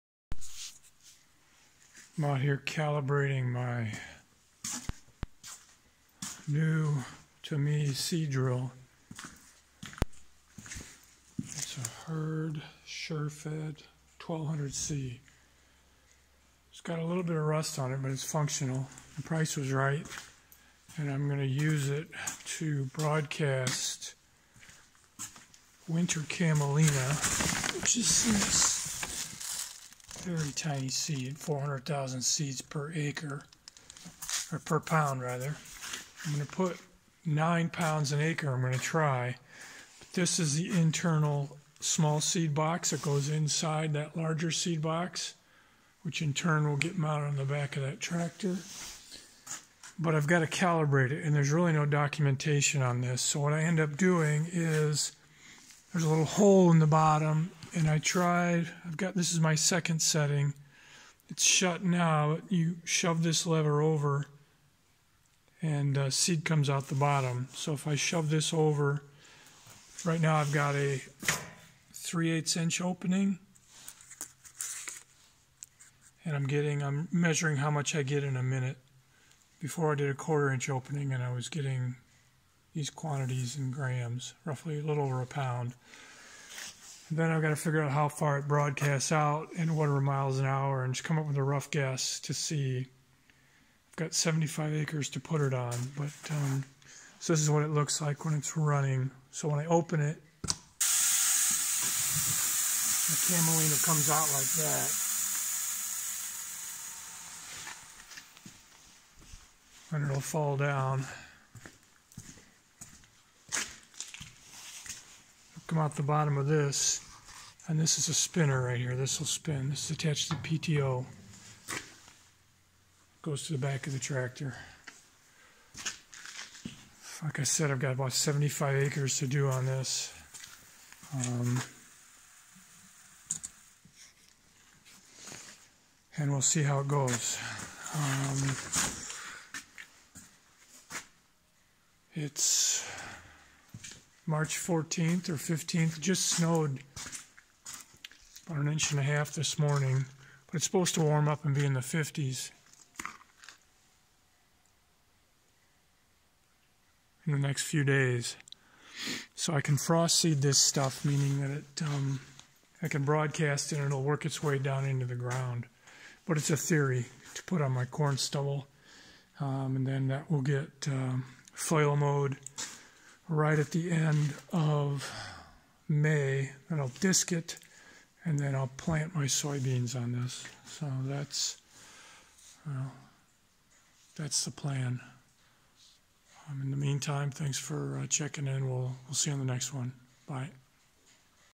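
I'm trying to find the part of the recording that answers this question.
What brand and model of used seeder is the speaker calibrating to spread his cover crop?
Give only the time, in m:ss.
0:12.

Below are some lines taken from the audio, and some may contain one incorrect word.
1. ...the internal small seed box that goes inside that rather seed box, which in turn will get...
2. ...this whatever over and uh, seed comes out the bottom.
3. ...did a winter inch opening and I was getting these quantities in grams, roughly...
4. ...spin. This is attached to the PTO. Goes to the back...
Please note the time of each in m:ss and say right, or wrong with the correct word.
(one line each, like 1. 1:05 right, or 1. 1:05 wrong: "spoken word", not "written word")
1. 0:40 wrong: "larger", not "rather"
2. 1:03 wrong: "lever", not "whatever"
3. 1:19 wrong: "quarter", not "winter"
4. 1:59 right.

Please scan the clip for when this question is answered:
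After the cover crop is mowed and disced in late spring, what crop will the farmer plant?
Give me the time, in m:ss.
2:59.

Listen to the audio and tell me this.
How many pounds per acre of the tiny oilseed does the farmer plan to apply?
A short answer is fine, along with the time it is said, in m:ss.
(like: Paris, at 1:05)
9 pounds, at 0:37.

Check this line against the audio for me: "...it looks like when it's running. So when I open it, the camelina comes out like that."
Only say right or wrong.
right.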